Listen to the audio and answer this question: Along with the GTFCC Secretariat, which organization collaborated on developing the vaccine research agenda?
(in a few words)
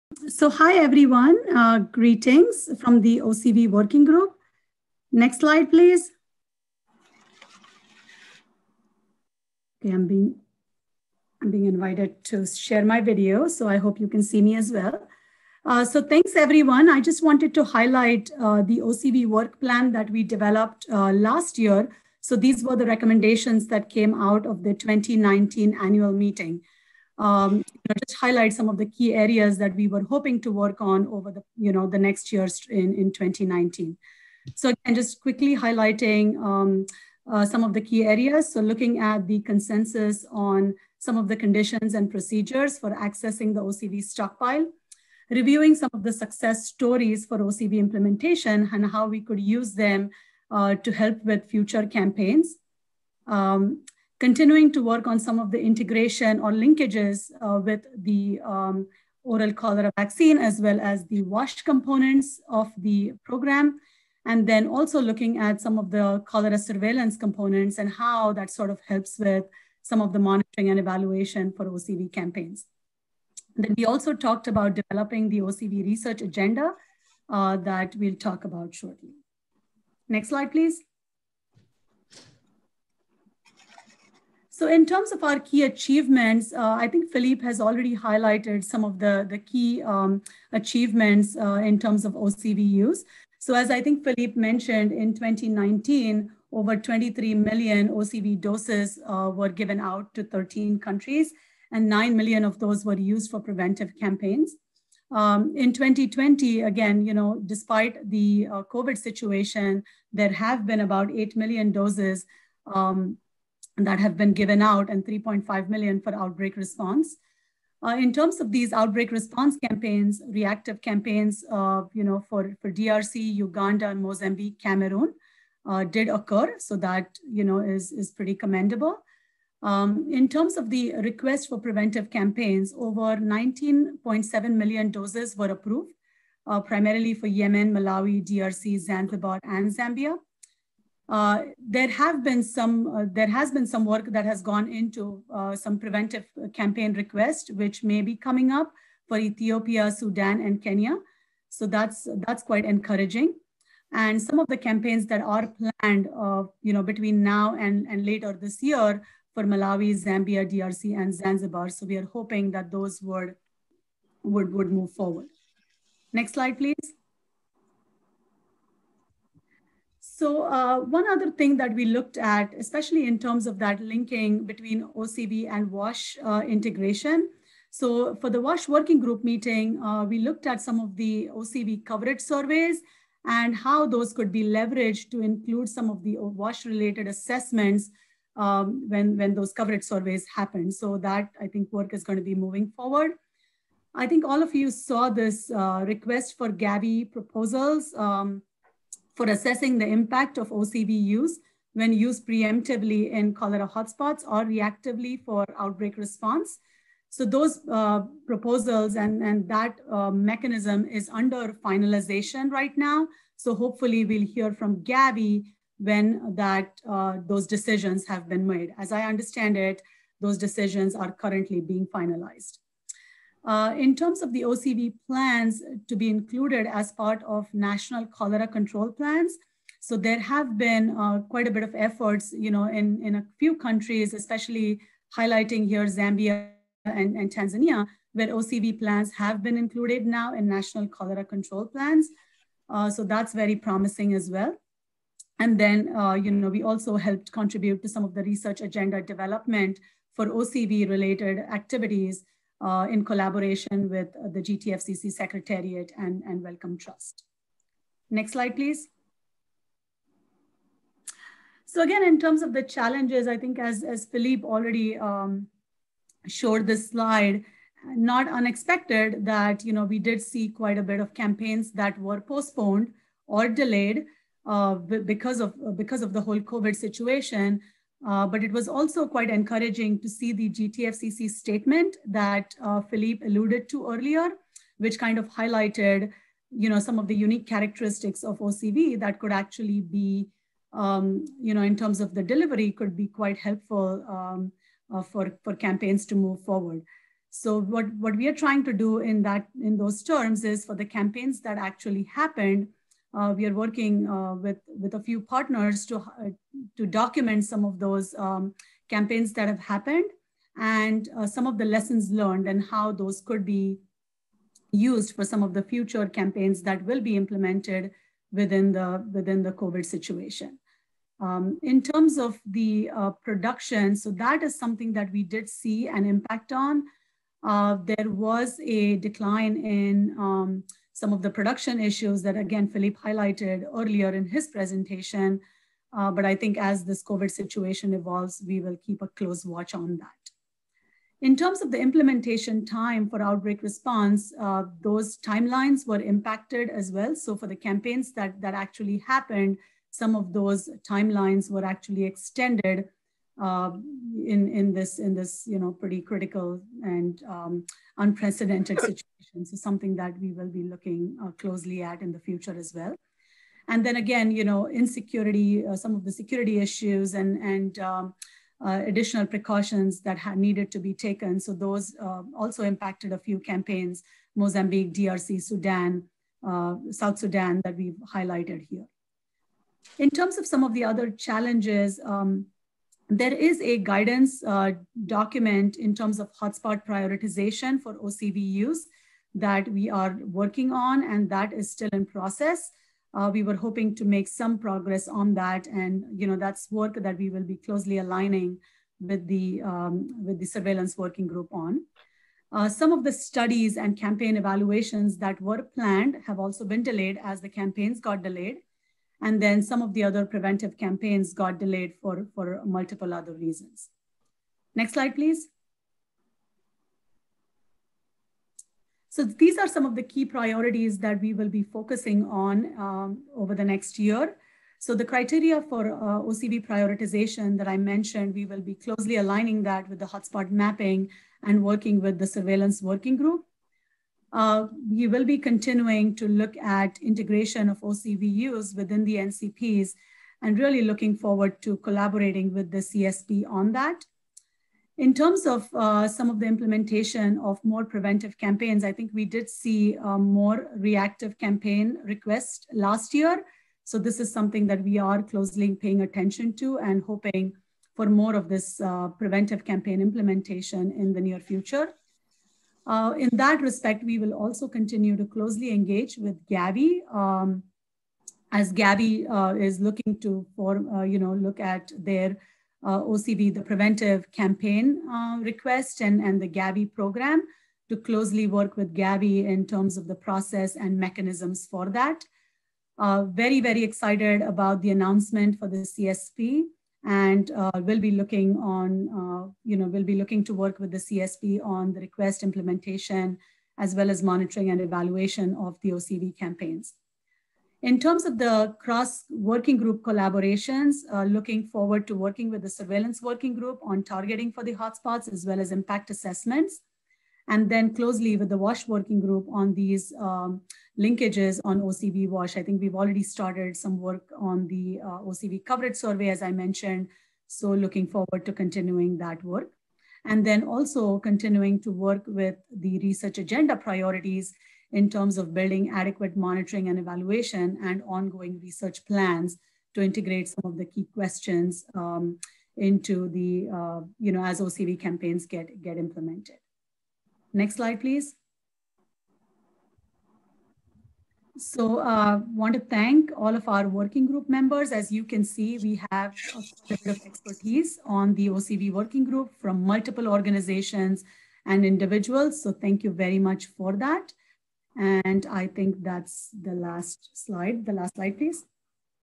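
Wellcome Trust.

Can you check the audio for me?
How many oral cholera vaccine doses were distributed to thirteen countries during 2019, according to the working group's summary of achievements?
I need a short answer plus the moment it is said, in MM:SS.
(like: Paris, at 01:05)
over 23 million, at 01:36.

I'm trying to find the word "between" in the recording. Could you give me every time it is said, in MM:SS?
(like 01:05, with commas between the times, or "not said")
02:36, 02:54.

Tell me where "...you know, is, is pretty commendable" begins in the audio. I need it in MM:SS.
02:07.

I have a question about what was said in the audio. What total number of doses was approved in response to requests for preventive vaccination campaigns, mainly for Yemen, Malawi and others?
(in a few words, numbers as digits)
19.7 million.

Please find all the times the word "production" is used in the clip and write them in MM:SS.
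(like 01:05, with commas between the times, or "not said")
05:23, 05:31.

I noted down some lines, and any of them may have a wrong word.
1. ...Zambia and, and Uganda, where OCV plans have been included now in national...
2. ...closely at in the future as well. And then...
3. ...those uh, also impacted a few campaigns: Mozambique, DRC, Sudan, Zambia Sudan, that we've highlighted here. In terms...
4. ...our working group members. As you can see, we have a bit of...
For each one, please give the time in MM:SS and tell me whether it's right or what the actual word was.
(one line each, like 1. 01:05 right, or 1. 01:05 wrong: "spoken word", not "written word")
1. 03:55 wrong: "Tanzania", not "Uganda"
2. 06:01 right
3. 06:11 wrong: "South", not "Zambia"
4. 09:03 right.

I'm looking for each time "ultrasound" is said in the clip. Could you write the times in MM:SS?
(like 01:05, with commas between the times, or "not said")
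not said.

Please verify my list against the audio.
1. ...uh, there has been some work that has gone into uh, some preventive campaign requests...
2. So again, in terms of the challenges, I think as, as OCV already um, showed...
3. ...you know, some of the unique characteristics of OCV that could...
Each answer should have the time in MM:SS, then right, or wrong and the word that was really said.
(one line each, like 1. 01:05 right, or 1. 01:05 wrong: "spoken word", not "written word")
1. 02:22 right
2. 04:21 wrong: "Philippe", not "OCV"
3. 04:46 right.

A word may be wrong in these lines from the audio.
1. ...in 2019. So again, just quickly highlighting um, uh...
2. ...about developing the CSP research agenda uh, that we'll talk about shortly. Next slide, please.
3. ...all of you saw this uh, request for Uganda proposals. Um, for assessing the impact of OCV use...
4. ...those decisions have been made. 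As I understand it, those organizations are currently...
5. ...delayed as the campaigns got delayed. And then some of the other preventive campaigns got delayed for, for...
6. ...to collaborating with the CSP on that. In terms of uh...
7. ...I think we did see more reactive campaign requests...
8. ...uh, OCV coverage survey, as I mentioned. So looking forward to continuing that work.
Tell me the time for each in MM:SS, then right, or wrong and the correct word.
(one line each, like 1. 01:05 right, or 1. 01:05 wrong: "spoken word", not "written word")
1. 00:32 right
2. 01:14 wrong: "OCV", not "CSP"
3. 03:14 wrong: "Gavi", not "Uganda"
4. 03:37 wrong: "decisions", not "organizations"
5. 06:46 right
6. 07:21 right
7. 07:28 right
8. 08:35 right.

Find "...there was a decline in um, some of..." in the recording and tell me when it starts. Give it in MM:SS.
05:27.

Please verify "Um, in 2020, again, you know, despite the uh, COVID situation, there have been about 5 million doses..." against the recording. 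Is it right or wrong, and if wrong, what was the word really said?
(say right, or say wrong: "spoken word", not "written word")
wrong: "8", not "5".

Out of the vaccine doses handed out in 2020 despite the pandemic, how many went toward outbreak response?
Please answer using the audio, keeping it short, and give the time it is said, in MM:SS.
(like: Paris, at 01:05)
3.5 million, at 01:55.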